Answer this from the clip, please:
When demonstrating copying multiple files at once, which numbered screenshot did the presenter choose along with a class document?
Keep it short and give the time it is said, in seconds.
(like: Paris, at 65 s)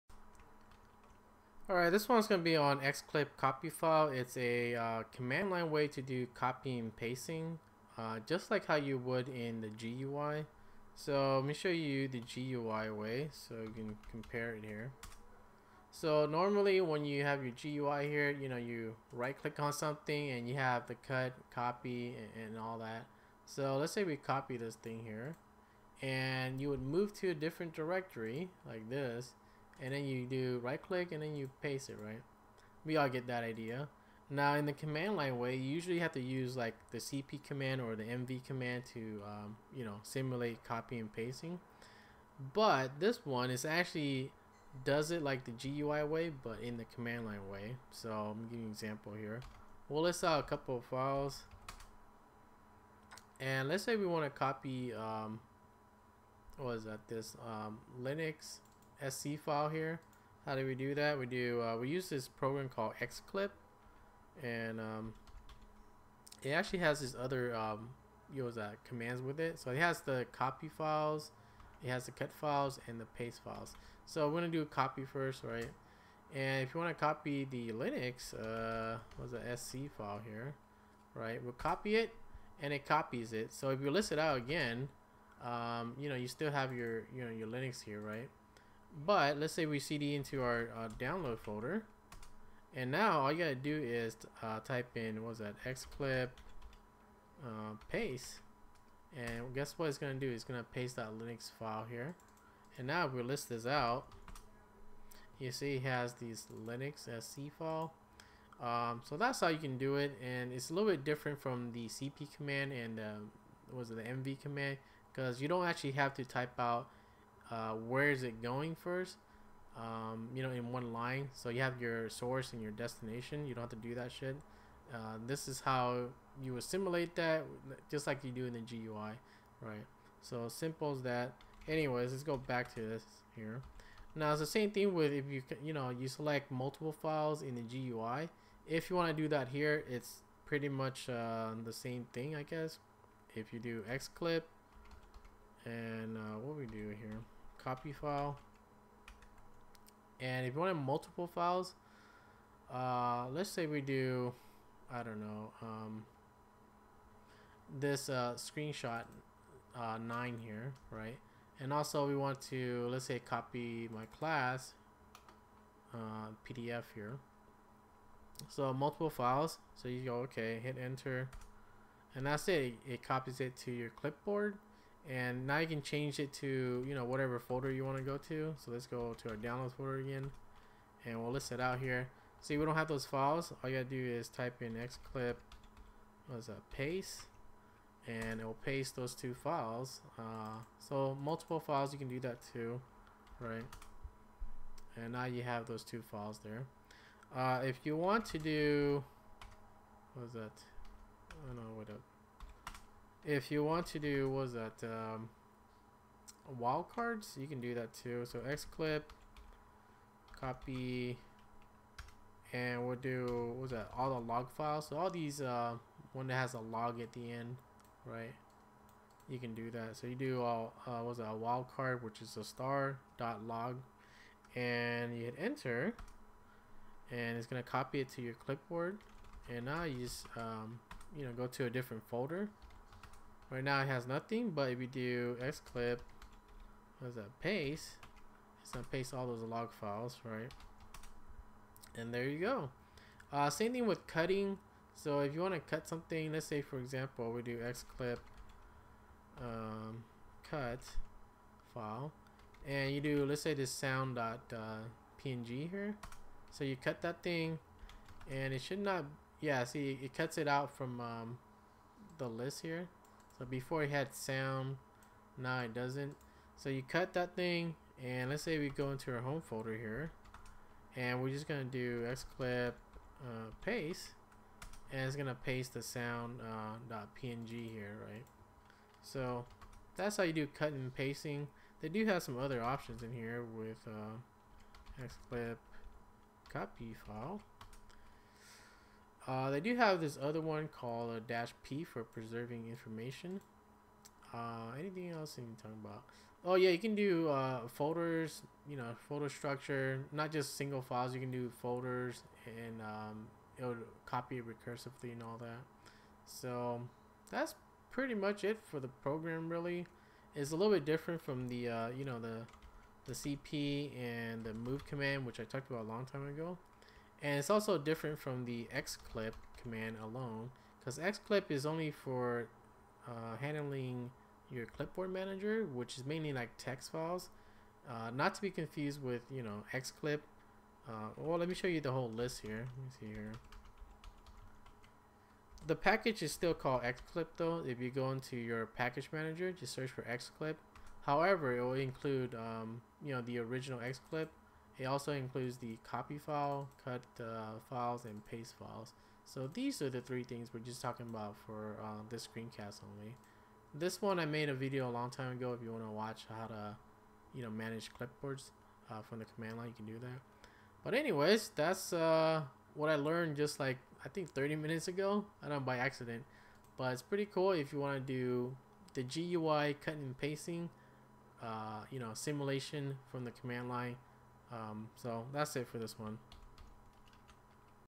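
Screenshot 9, at 158 s.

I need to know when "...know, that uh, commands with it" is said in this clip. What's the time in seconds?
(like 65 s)
68 s.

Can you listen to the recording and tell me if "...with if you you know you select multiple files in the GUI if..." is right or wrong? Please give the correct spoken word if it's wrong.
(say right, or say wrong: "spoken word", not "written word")
right.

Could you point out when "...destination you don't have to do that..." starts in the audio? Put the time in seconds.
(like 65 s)
122 s.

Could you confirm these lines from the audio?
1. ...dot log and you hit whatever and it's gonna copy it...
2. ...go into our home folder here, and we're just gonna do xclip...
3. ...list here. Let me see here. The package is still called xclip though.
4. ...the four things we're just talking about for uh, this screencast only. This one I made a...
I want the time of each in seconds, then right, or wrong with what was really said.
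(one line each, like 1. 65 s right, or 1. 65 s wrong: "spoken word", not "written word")
1. 223 s wrong: "enter", not "whatever"
2. 268 s right
3. 332 s right
4. 349 s wrong: "three", not "four".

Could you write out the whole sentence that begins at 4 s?
It's a uh, command line way to do copy and pasting, uh, just like how you would in the GUI.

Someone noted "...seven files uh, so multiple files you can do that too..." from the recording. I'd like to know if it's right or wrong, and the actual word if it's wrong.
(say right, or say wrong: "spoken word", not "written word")
wrong: "two", not "seven".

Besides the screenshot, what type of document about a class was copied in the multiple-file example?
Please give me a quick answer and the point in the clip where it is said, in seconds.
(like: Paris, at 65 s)
PDF, at 166 s.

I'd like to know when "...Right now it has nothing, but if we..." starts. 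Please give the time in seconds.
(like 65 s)
233 s.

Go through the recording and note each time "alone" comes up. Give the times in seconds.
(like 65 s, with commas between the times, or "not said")
320 s.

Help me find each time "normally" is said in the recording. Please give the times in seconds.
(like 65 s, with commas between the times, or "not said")
16 s.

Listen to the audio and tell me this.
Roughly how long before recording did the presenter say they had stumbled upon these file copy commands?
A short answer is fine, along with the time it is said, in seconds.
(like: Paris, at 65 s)
30 minutes, at 364 s.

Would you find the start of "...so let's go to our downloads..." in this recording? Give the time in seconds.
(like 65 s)
178 s.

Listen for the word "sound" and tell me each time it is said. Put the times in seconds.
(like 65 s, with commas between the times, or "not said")
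253 s, 264 s, 275 s.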